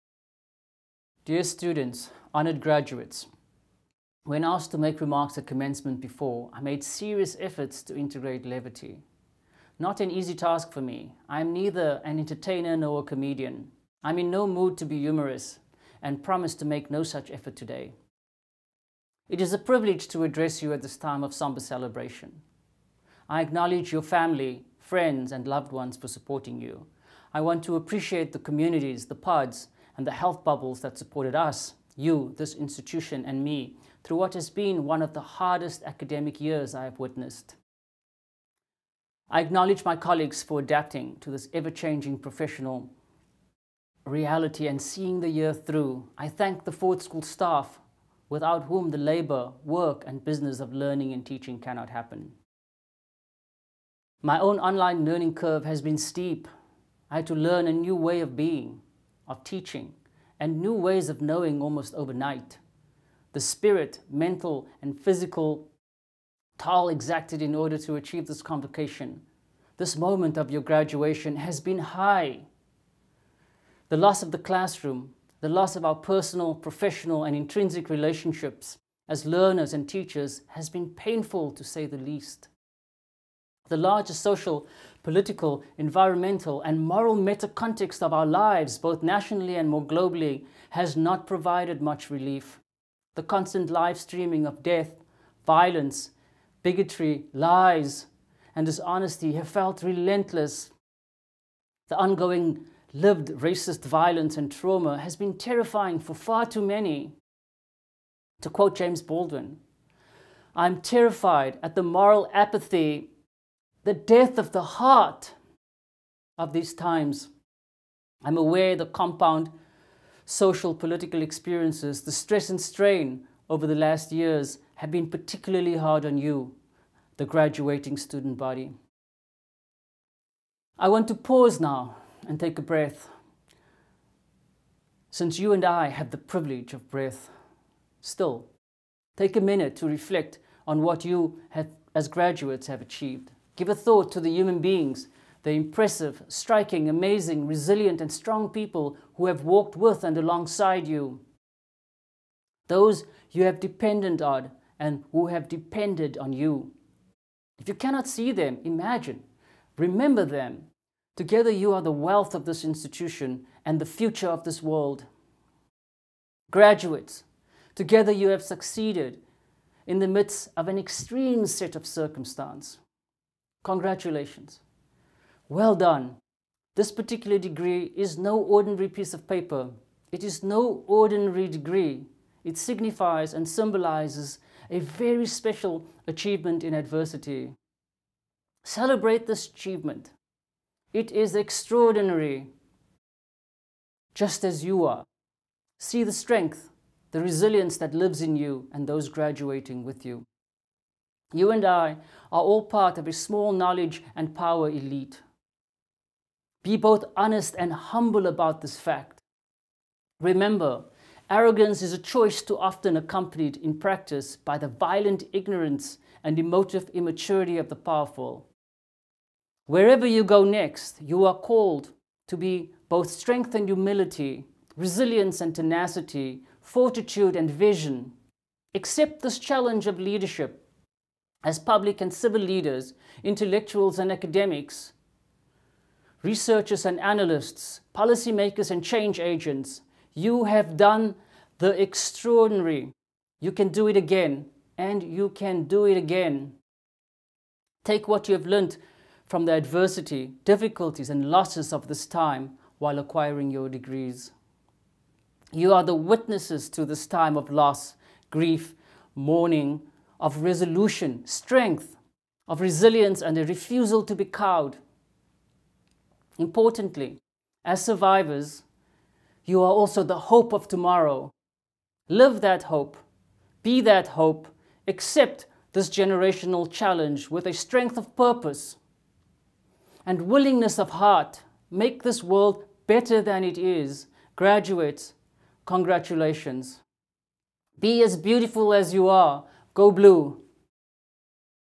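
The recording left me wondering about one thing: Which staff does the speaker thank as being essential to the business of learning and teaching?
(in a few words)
Ford School staff.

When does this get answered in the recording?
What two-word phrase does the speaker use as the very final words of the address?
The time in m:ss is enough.
4:49.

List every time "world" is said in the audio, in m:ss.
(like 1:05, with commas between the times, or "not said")
2:44, 4:42.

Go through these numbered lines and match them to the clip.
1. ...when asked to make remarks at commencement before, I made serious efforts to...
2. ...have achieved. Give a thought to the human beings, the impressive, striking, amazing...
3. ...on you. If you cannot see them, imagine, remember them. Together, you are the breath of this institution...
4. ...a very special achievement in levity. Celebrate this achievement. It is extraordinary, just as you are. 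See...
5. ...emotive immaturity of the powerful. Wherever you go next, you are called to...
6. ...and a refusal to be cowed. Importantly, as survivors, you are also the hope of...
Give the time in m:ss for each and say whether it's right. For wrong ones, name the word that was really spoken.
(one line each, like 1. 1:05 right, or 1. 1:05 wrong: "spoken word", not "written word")
1. 0:04 right
2. 2:22 right
3. 2:36 wrong: "wealth", not "breath"
4. 3:04 wrong: "adversity", not "levity"
5. 3:36 right
6. 4:23 right.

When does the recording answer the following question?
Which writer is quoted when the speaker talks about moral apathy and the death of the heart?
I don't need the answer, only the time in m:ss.
1:48.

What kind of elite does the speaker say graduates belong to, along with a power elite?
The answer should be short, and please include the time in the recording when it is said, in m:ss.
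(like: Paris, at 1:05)
knowledge, at 3:23.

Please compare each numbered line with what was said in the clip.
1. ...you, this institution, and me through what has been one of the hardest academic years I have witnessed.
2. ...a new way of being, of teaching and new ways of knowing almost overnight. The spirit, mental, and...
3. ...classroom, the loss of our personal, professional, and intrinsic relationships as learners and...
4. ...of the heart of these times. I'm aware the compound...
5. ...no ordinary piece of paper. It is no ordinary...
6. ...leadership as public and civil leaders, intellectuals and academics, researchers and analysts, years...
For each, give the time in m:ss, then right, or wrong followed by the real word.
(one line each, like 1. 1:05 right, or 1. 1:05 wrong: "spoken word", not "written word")
1. 0:31 right
2. 0:57 right
3. 1:14 right
4. 1:54 right
5. 2:58 right
6. 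3:49 wrong: "policymakers", not "years".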